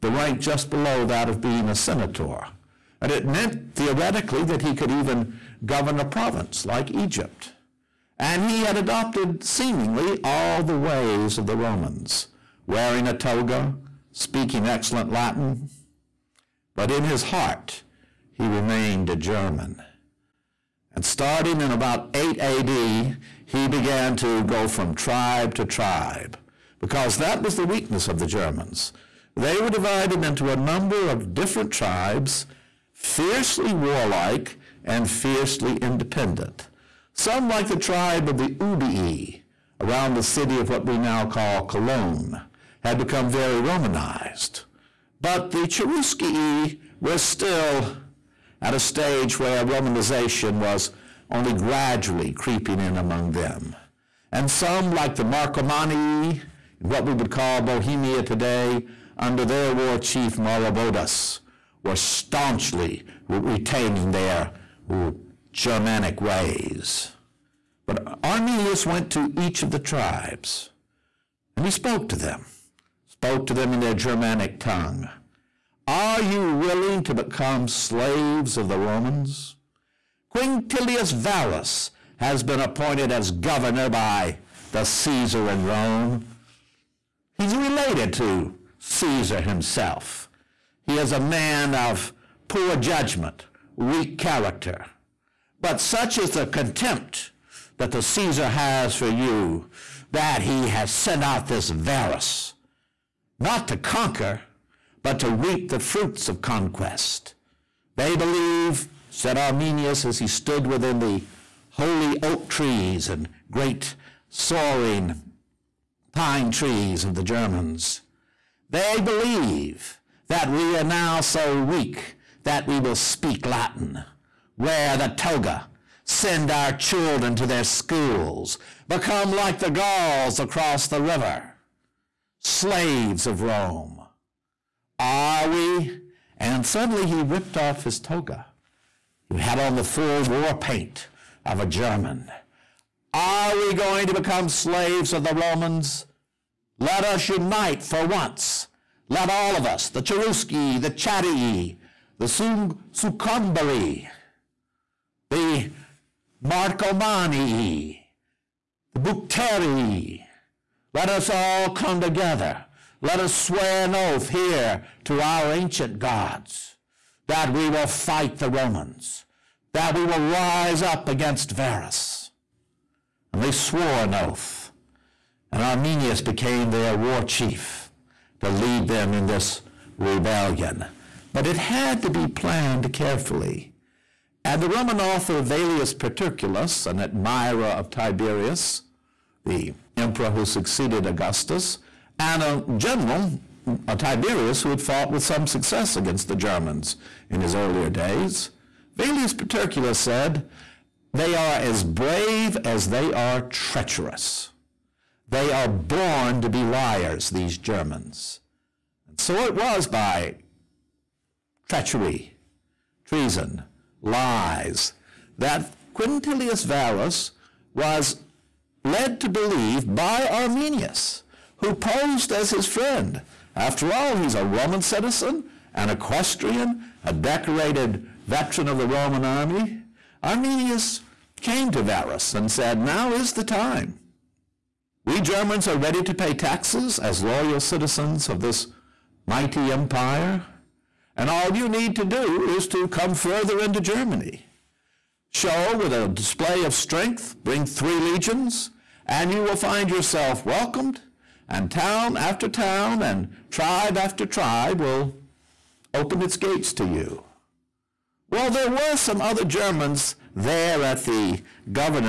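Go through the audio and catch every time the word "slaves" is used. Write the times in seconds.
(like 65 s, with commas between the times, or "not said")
77 s, 132 s, 144 s.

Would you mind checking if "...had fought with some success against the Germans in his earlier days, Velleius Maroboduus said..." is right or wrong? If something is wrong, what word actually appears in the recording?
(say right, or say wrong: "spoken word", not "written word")
wrong: "Paterculus", not "Maroboduus".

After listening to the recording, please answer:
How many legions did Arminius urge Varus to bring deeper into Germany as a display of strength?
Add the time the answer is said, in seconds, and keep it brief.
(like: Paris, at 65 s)
3, at 247 s.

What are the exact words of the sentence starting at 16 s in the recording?
But in his heart, he remained a German.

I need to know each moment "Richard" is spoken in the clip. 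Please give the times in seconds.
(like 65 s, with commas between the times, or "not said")
not said.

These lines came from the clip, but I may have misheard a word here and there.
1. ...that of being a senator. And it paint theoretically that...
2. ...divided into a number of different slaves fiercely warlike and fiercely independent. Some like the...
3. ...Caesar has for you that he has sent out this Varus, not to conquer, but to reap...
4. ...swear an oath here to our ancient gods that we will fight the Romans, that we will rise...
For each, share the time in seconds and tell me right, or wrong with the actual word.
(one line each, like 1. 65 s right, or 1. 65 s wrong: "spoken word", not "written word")
1. 1 s wrong: "meant", not "paint"
2. 29 s wrong: "tribes", not "slaves"
3. 98 s right
4. 163 s right.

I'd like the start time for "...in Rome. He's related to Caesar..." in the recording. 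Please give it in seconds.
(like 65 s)
85 s.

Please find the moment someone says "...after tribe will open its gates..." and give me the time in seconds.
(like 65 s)
253 s.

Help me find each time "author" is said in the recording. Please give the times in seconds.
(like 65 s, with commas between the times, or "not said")
184 s.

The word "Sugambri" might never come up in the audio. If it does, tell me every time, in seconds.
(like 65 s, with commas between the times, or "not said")
152 s.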